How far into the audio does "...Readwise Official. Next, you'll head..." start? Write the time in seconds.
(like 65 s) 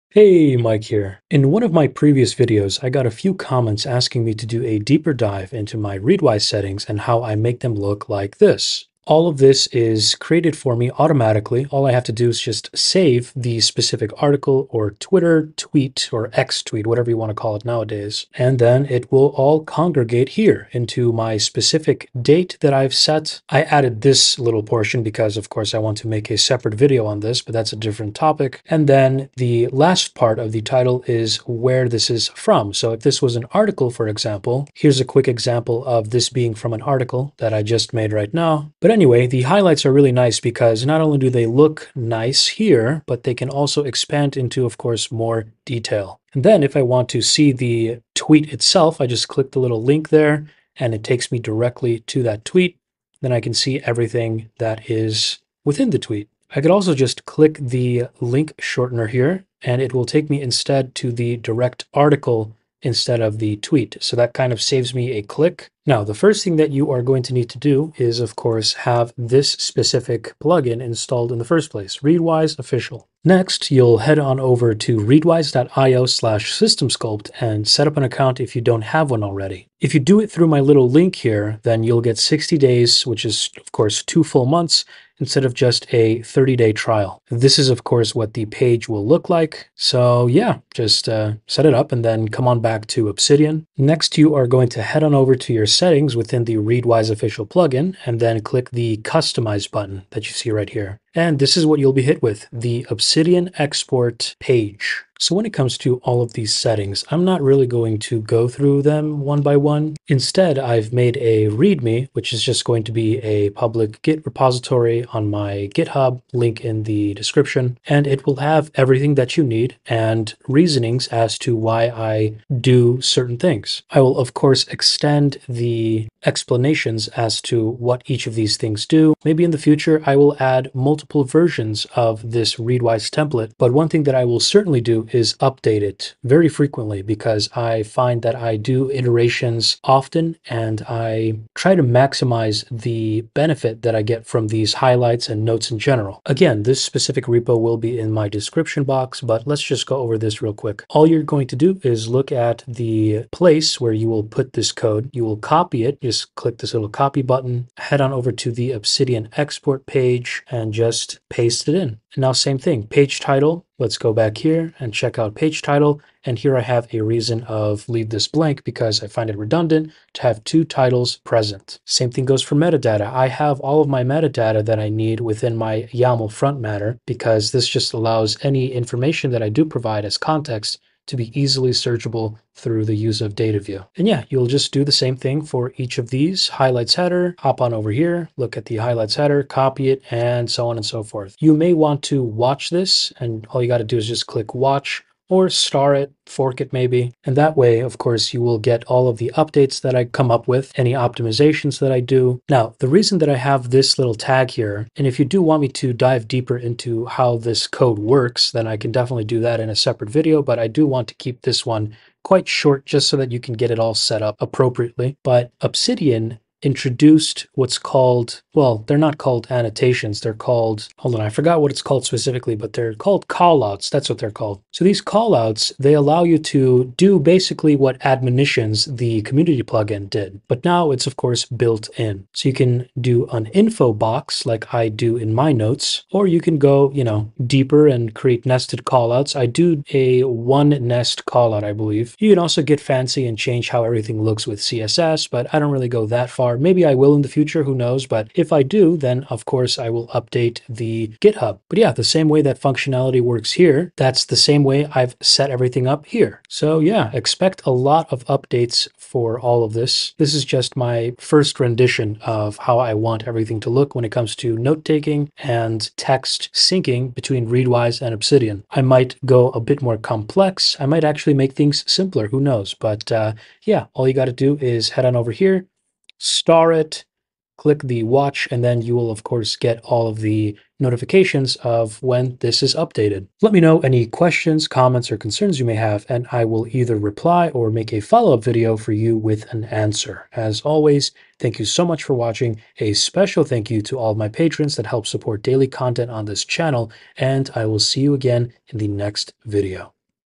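71 s.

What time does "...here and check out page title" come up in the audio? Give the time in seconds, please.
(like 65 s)
164 s.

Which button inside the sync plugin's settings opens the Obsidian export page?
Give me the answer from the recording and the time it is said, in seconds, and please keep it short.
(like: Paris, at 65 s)
Customize, at 98 s.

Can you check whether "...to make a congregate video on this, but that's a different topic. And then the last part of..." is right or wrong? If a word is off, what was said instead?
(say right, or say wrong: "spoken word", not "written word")
wrong: "separate", not "congregate".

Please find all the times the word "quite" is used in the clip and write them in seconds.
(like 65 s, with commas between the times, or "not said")
212 s.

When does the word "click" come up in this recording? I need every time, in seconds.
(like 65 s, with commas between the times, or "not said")
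49 s, 57 s, 65 s, 98 s, 156 s, 194 s, 277 s.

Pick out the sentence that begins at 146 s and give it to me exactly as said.
Again, this specific repo will be in my description box, but let's just go over this real quick.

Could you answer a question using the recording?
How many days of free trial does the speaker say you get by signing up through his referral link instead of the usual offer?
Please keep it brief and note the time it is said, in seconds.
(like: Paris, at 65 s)
60, at 82 s.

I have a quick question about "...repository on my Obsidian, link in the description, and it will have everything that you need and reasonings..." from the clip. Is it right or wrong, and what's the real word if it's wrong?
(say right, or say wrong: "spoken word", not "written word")
wrong: "GitHub", not "Obsidian".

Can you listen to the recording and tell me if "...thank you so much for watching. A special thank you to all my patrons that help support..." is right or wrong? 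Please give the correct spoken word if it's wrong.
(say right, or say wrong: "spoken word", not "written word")
right.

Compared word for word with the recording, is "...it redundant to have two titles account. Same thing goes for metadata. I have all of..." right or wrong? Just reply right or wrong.
wrong.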